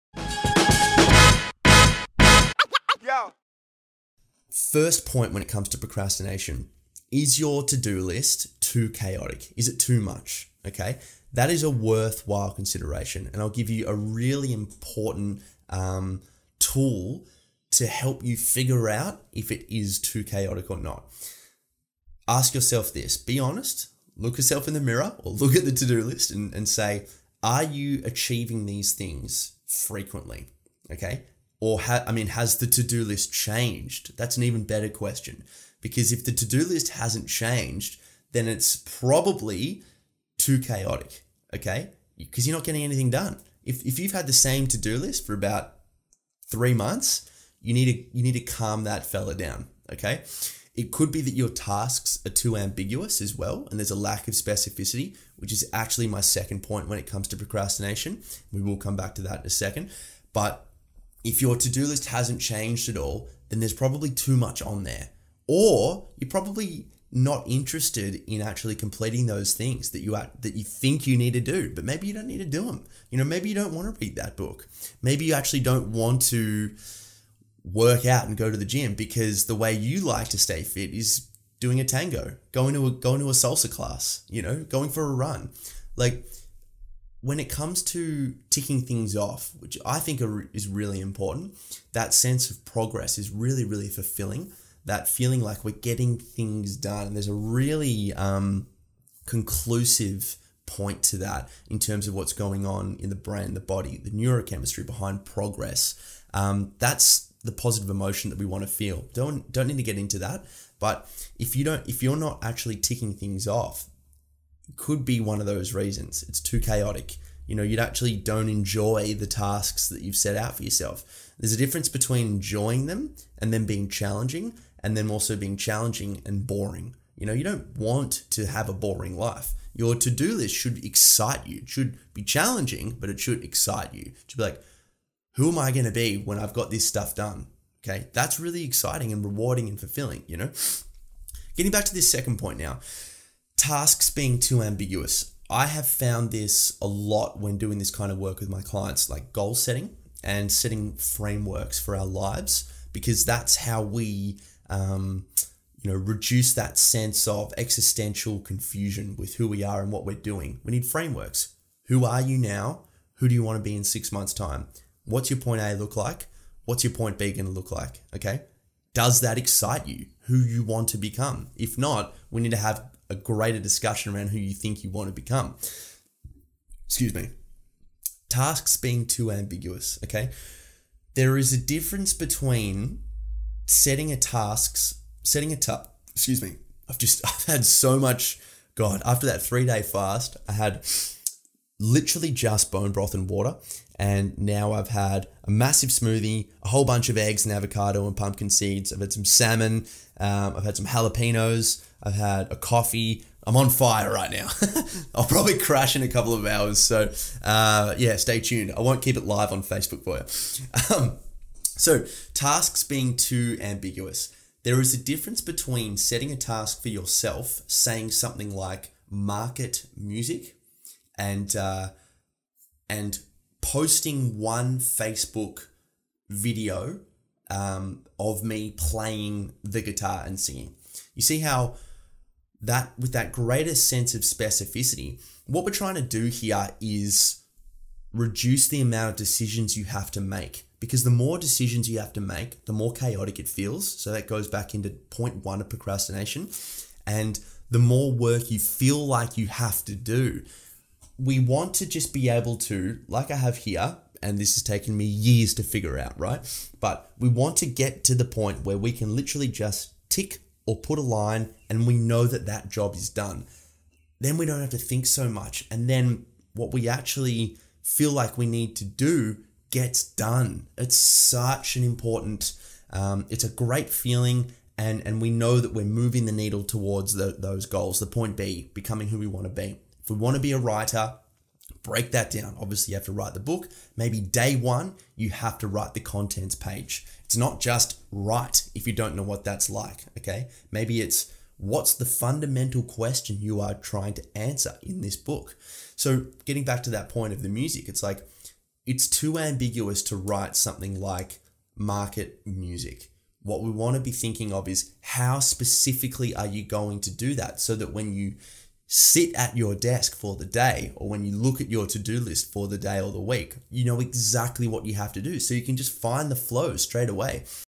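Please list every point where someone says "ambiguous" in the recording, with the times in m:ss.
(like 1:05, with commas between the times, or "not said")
0:52, 2:24, 2:59, 3:33, 4:59.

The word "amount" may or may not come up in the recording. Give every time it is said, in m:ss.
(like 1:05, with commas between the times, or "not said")
3:58.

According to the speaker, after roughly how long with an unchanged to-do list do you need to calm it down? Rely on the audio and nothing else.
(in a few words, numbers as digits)
3 months.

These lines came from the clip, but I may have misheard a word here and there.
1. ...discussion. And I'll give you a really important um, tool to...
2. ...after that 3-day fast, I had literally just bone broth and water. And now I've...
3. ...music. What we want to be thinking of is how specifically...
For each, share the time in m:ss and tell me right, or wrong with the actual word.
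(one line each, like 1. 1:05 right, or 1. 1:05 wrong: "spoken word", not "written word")
1. 0:12 wrong: "consideration", not "discussion"
2. 3:09 right
3. 5:02 right.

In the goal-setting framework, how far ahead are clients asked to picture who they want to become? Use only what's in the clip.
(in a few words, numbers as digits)
6 months.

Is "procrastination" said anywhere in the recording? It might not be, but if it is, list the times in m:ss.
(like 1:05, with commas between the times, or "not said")
0:05, 0:57, 4:05.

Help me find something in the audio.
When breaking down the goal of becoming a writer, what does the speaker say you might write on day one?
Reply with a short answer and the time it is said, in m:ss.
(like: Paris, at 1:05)
contents page, at 4:45.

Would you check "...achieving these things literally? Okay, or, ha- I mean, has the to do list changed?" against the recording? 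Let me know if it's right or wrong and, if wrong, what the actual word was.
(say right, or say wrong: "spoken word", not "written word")
wrong: "frequently", not "literally".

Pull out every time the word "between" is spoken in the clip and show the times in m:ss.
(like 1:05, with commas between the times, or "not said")
2:01, 3:02, 3:35.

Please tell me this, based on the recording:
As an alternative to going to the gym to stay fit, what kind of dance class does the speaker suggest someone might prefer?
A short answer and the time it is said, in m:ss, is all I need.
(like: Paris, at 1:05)
salsa class, at 1:23.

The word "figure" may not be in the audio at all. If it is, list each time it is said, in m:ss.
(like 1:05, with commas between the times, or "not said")
0:18, 4:15.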